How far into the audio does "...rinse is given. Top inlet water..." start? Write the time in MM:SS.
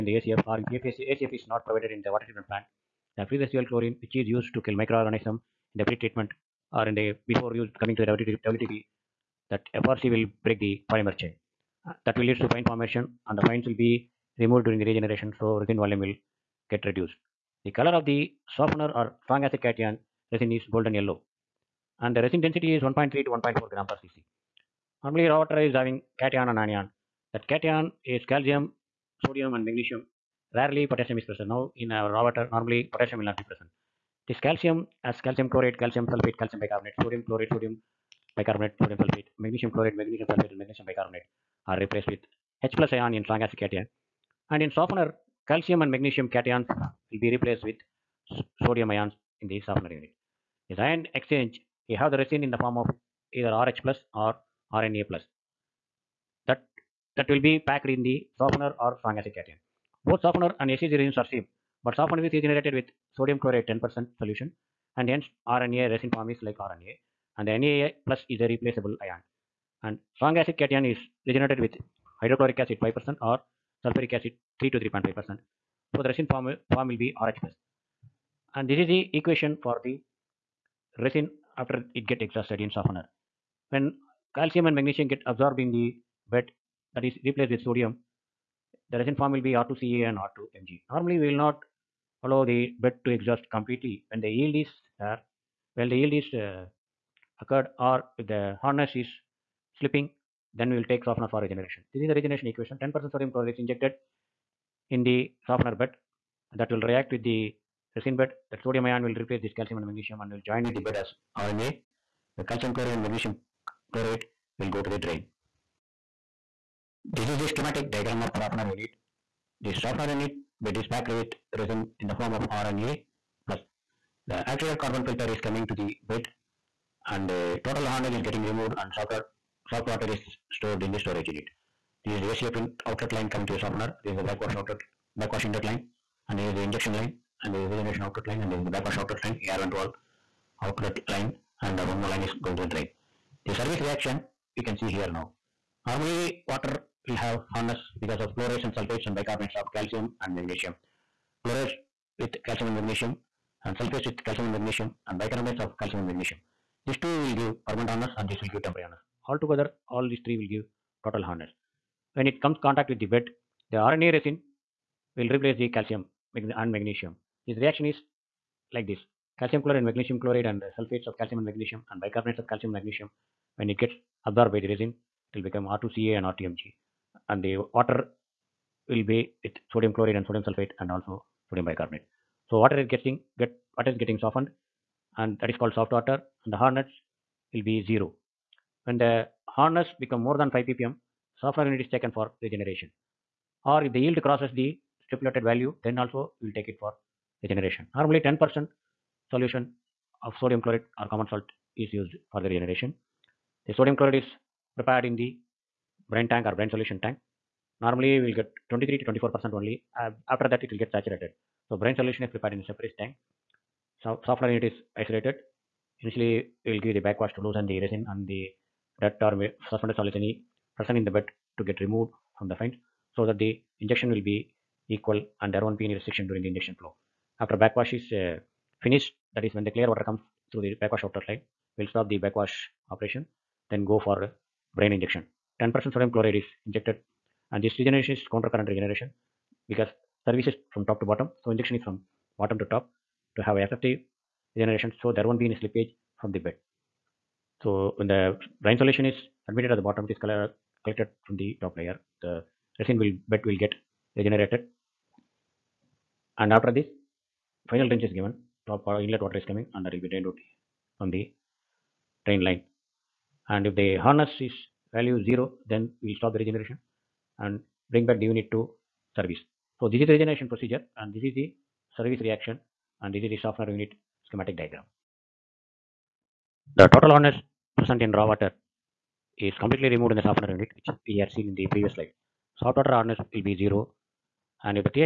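04:17.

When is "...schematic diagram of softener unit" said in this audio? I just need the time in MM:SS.
01:57.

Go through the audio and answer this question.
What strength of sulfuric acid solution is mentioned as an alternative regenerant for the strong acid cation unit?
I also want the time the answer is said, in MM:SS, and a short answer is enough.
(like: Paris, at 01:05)
3 to 3.5%, at 01:14.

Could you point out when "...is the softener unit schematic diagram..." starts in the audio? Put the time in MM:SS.
04:33.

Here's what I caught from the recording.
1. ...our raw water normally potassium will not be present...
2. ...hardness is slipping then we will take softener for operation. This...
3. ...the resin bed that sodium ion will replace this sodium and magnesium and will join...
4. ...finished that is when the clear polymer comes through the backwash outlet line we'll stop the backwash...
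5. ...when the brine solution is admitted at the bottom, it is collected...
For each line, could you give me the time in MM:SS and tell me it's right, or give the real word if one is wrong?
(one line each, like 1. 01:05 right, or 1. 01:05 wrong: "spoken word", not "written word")
1. 00:31 right
2. 01:38 wrong: "regeneration", not "operation"
3. 01:47 wrong: "calcium", not "sodium"
4. 03:48 wrong: "water", not "polymer"
5. 04:07 right.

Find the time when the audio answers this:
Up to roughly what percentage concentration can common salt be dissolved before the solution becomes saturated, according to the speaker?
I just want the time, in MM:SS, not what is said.
03:28.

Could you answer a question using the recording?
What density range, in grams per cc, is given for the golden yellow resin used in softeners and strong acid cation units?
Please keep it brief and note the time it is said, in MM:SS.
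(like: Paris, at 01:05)
1.3 to 1.4, at 00:22.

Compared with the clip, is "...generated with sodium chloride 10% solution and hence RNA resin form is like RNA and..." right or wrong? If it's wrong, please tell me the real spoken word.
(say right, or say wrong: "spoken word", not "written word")
right.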